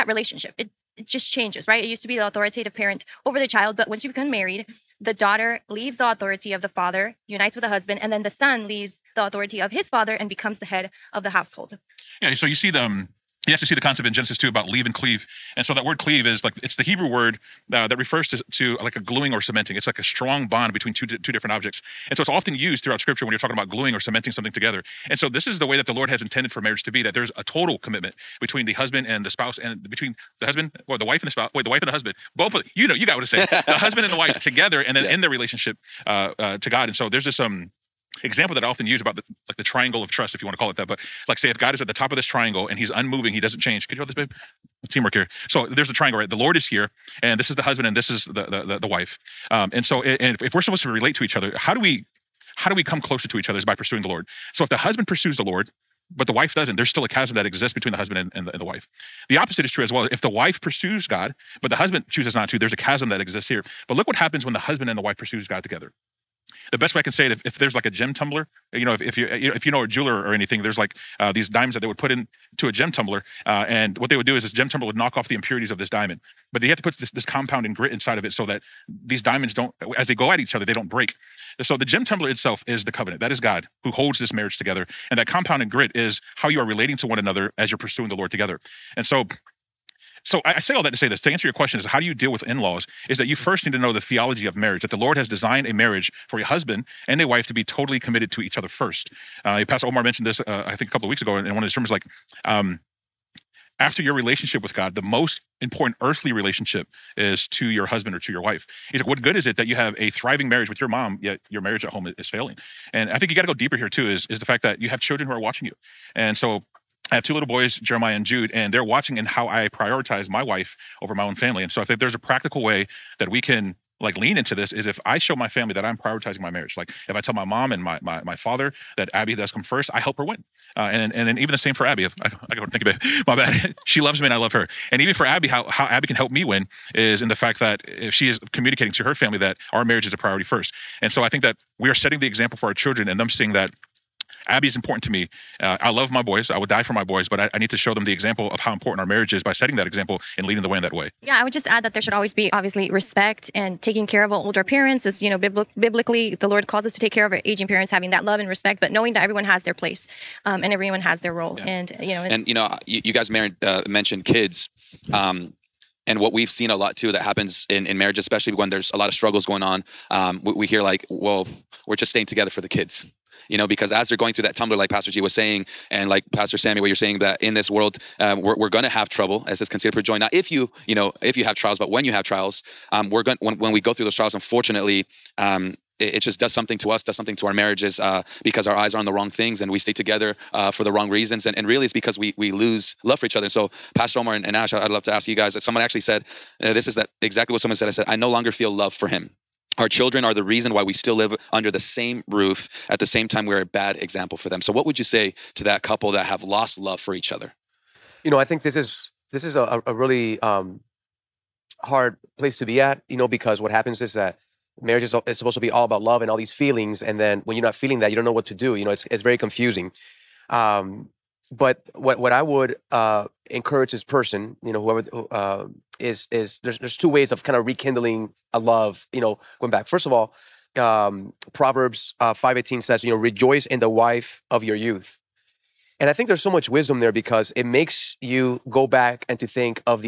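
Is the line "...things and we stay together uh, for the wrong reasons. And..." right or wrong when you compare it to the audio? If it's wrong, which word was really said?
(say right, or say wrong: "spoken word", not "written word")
right.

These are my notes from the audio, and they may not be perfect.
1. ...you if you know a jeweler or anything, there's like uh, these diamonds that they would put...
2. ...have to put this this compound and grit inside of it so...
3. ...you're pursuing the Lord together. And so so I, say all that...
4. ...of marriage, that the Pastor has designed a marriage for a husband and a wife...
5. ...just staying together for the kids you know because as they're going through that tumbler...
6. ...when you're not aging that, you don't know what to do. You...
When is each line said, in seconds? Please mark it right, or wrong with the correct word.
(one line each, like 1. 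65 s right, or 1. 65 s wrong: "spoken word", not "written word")
1. 69 s right
2. 76 s right
3. 87 s right
4. 94 s wrong: "Lord", not "Pastor"
5. 171 s right
6. 217 s wrong: "feeling", not "aging".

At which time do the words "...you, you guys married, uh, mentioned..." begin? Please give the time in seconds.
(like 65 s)
162 s.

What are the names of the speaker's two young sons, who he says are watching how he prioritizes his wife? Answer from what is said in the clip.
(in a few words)
Jeremiah and Jude.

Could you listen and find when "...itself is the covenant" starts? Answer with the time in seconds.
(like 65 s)
82 s.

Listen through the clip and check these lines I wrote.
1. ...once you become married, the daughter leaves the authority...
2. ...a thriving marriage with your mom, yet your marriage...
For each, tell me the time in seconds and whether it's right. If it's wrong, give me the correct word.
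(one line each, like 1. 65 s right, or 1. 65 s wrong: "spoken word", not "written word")
1. 3 s right
2. 109 s right.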